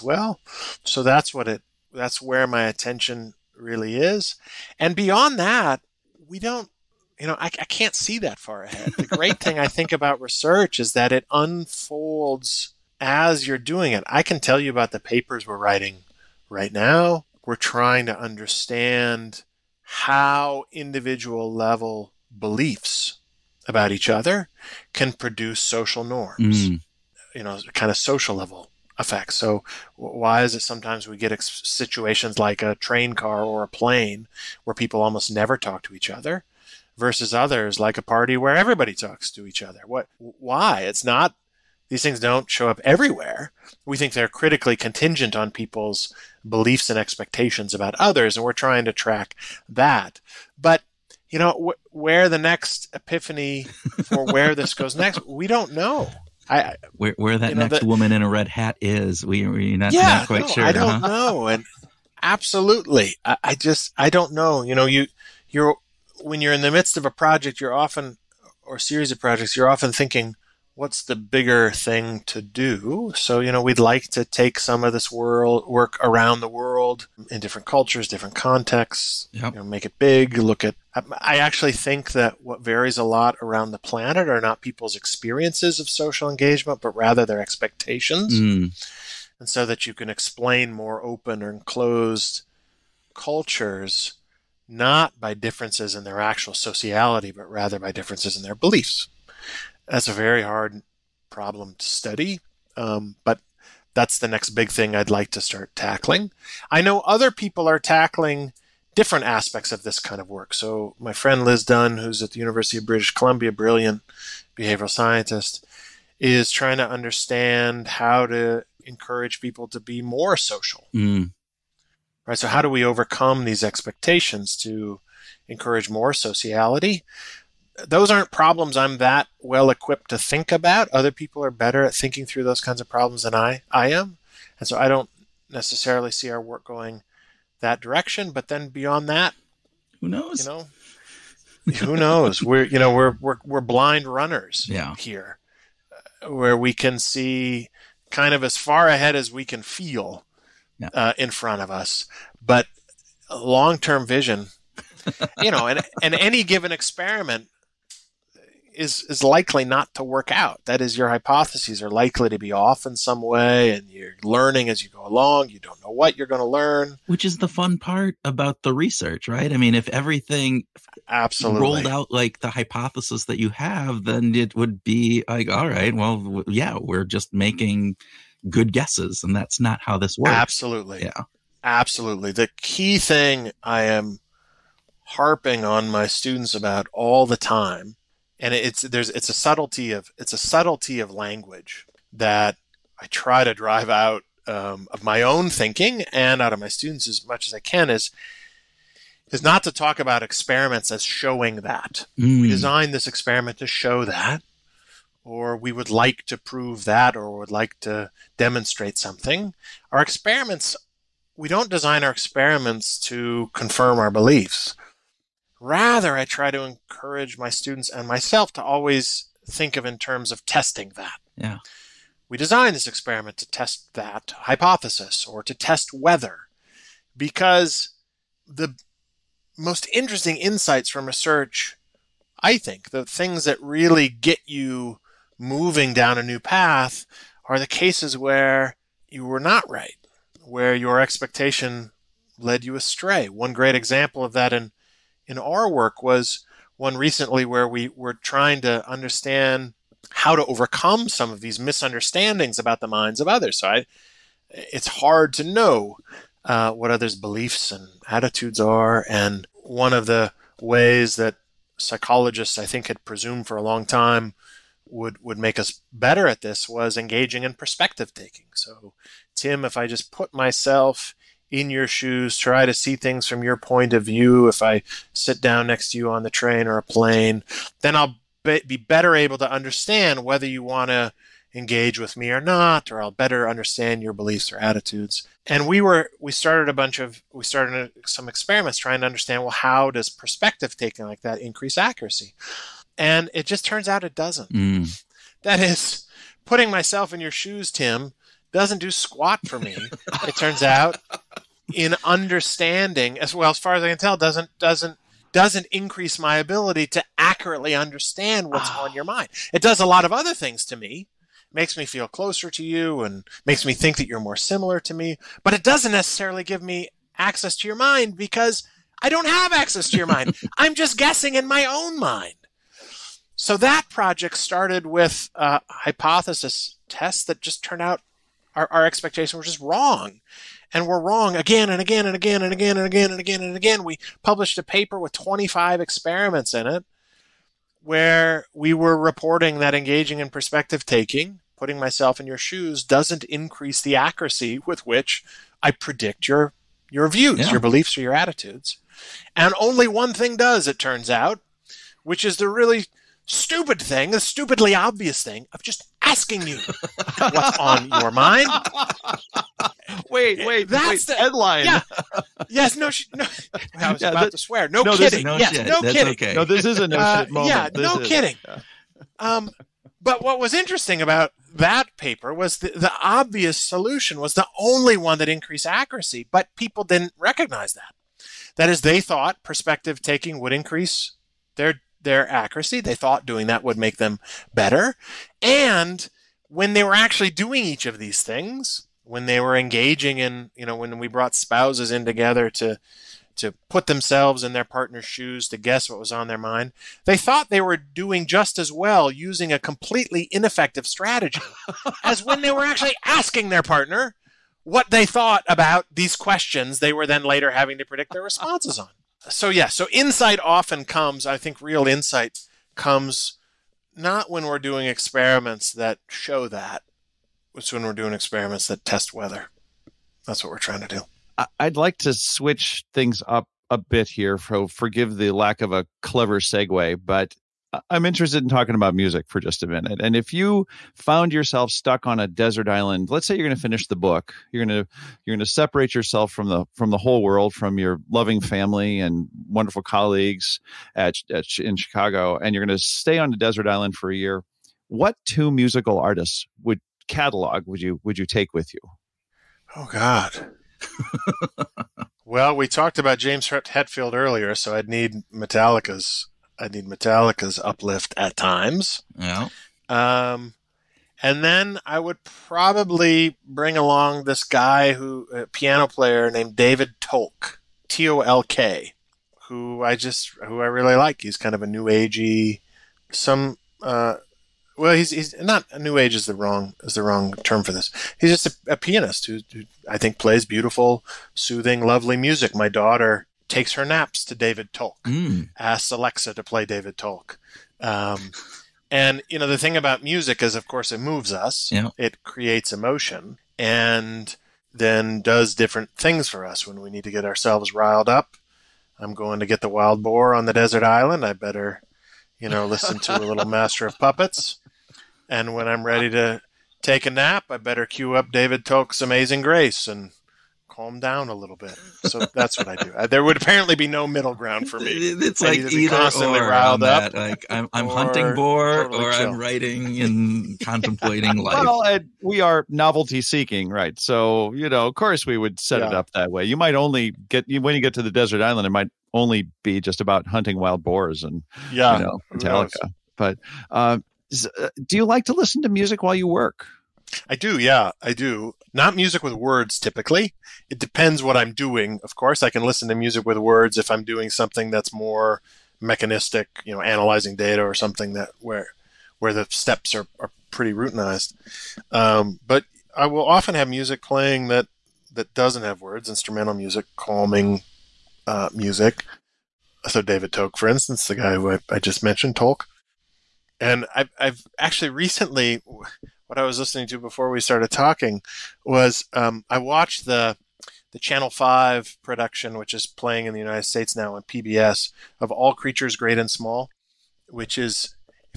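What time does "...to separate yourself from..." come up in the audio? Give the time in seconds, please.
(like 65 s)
435 s.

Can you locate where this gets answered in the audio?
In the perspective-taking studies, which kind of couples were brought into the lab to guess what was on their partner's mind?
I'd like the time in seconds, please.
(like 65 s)
391 s.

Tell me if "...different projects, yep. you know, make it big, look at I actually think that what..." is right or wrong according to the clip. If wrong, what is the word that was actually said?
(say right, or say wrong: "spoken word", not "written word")
wrong: "contexts", not "projects".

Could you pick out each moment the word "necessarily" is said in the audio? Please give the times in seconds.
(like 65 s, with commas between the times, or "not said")
135 s, 315 s.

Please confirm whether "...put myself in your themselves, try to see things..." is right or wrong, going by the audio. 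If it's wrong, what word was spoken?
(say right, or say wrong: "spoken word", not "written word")
wrong: "shoes", not "themselves".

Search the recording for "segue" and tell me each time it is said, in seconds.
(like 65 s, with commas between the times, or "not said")
426 s.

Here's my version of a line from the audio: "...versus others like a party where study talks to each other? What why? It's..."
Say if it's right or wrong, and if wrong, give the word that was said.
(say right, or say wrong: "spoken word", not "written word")
wrong: "everybody", not "study".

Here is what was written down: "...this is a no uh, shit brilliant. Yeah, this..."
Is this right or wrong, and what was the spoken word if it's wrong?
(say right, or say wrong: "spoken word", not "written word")
wrong: "moment", not "brilliant".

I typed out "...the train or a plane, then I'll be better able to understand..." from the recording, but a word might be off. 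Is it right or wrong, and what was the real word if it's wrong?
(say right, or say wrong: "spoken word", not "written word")
right.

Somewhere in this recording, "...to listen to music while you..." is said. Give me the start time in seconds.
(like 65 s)
535 s.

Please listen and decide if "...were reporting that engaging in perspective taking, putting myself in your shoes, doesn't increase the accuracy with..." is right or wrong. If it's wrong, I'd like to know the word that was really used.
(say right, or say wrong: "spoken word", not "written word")
right.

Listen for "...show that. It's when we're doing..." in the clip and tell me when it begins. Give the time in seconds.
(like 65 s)
416 s.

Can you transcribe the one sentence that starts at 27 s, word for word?
you know, kind of social level effects.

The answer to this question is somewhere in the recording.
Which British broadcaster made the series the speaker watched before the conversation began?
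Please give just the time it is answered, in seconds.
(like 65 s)
570 s.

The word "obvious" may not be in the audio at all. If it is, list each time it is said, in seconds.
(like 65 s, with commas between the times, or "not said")
354 s, 373 s.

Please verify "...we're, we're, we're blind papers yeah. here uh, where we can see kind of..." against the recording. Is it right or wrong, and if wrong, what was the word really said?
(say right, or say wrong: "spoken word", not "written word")
wrong: "runners", not "papers".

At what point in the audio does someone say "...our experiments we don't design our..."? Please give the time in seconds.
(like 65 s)
209 s.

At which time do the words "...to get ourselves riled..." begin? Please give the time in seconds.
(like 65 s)
497 s.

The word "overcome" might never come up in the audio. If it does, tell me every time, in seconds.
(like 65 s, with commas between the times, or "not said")
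122 s, 250 s.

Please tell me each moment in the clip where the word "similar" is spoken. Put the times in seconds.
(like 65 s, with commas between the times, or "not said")
314 s.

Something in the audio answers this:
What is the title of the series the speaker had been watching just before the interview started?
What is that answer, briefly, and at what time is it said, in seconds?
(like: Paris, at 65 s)
All Creatures Great and Small, at 575 s.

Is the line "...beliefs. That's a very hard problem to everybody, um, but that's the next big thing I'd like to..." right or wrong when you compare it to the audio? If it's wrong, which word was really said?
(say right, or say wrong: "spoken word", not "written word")
wrong: "study", not "everybody".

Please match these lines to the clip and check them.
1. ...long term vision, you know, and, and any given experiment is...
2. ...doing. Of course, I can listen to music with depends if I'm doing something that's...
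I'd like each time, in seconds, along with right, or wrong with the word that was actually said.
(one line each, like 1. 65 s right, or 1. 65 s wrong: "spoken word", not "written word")
1. 153 s right
2. 541 s wrong: "words", not "depends".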